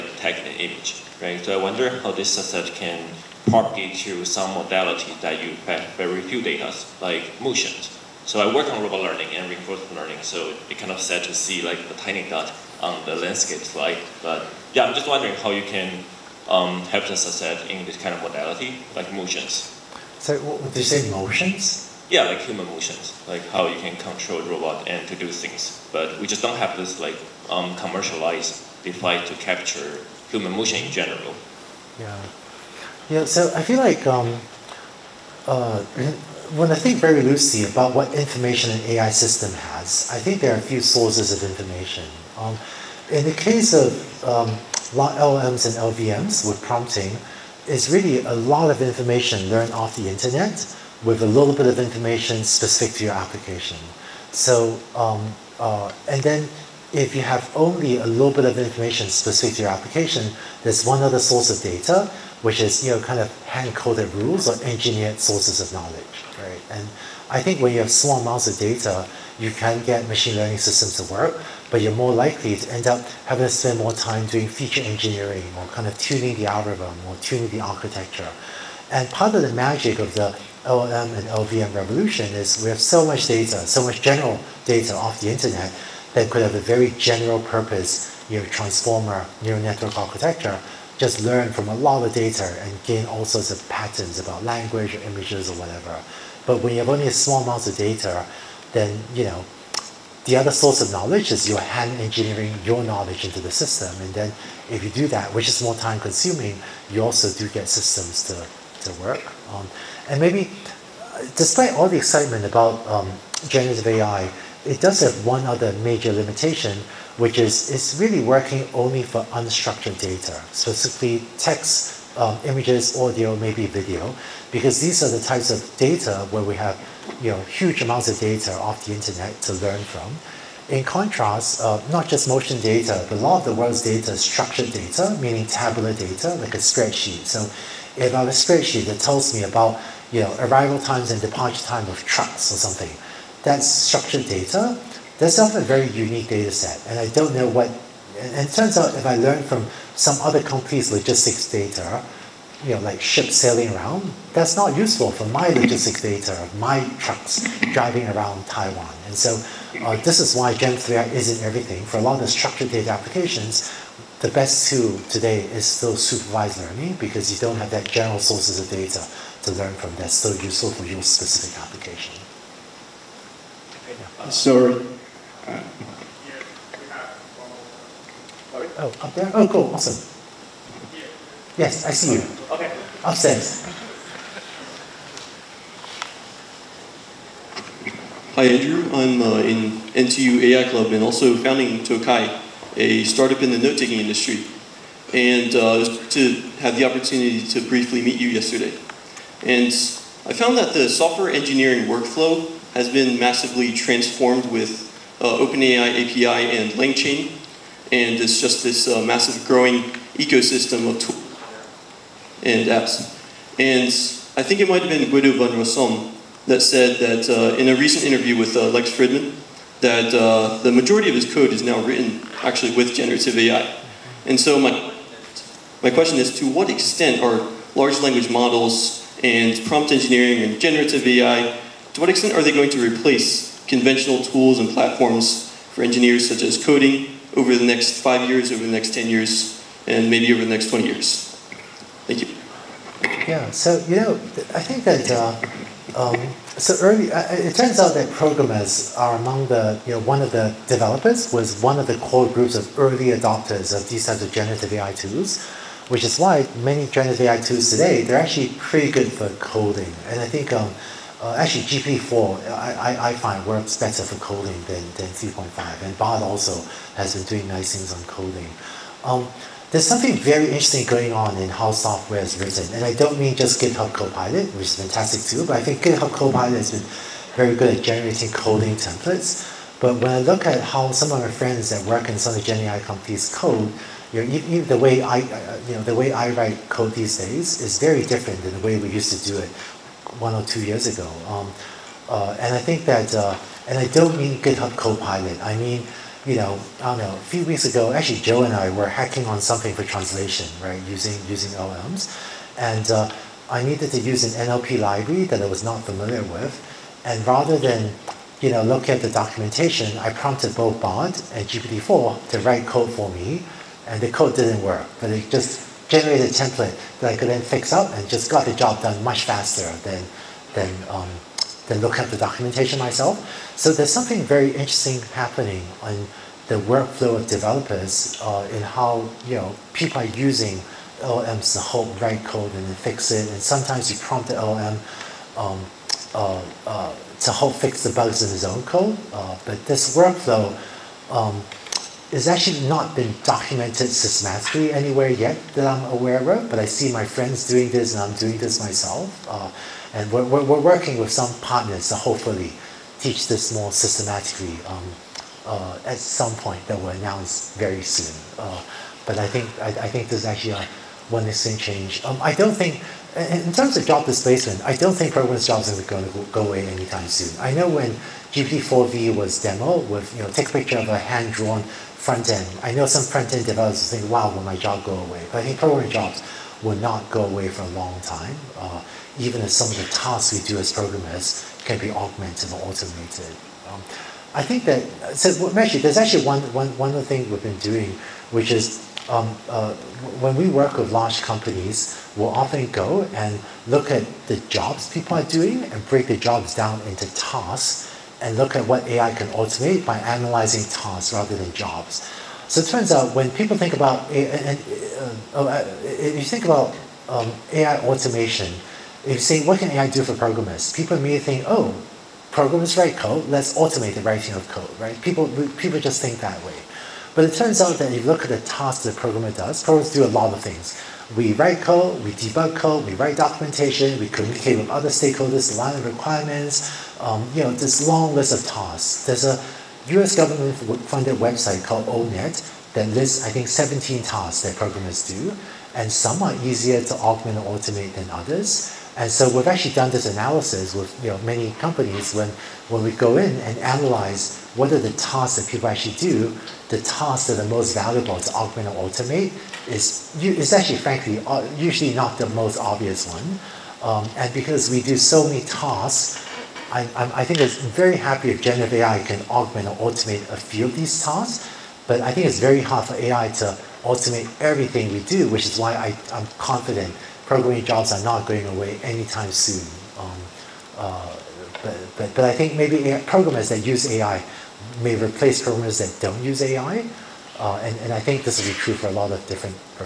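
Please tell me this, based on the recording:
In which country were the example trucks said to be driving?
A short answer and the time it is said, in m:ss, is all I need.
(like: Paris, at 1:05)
Taiwan, at 2:38.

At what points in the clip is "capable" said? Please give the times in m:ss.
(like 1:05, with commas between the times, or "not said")
not said.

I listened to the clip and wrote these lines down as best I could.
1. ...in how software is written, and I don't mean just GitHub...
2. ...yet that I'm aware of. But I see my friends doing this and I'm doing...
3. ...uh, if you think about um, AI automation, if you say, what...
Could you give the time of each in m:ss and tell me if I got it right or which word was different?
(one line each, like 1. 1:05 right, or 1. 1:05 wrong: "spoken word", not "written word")
1. 4:31 right
2. 5:45 right
3. 6:45 right.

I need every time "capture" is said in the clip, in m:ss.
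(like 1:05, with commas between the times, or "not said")
0:29.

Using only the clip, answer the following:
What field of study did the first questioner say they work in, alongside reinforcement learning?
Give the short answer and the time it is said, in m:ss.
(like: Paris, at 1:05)
robot learning, at 0:08.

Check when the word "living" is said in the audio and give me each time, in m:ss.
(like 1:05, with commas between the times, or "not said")
not said.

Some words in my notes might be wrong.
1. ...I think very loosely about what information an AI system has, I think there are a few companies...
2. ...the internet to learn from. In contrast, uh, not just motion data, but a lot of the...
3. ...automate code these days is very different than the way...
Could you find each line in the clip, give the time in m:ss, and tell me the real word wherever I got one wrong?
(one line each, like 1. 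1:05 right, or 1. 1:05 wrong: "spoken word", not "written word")
1. 0:36 wrong: "sources", not "companies"
2. 2:08 right
3. 4:46 wrong: "write", not "automate".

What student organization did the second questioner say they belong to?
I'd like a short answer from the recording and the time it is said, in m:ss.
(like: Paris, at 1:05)
NTU AI Club, at 3:09.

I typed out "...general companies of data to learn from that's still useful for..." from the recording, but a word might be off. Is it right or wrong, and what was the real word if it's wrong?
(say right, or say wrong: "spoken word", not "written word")
wrong: "sources", not "companies".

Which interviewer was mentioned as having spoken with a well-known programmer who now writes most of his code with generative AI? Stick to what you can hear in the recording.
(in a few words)
Lex Fridman.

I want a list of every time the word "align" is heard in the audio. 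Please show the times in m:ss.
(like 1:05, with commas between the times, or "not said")
7:05.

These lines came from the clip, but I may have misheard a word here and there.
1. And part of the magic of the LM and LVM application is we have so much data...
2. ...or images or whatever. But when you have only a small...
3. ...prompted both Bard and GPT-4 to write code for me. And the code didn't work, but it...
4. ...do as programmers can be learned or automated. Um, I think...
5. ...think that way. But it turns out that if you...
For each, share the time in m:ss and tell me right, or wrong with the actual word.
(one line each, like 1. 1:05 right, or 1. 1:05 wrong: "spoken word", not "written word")
1. 1:18 wrong: "revolution", not "application"
2. 1:34 right
3. 5:10 right
4. 6:20 wrong: "augmented", not "learned"
5. 6:56 right.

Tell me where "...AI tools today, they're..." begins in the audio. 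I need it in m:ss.
4:17.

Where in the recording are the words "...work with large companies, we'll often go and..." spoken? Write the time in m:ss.
6:30.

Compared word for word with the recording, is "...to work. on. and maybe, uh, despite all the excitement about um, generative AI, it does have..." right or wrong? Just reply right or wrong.
right.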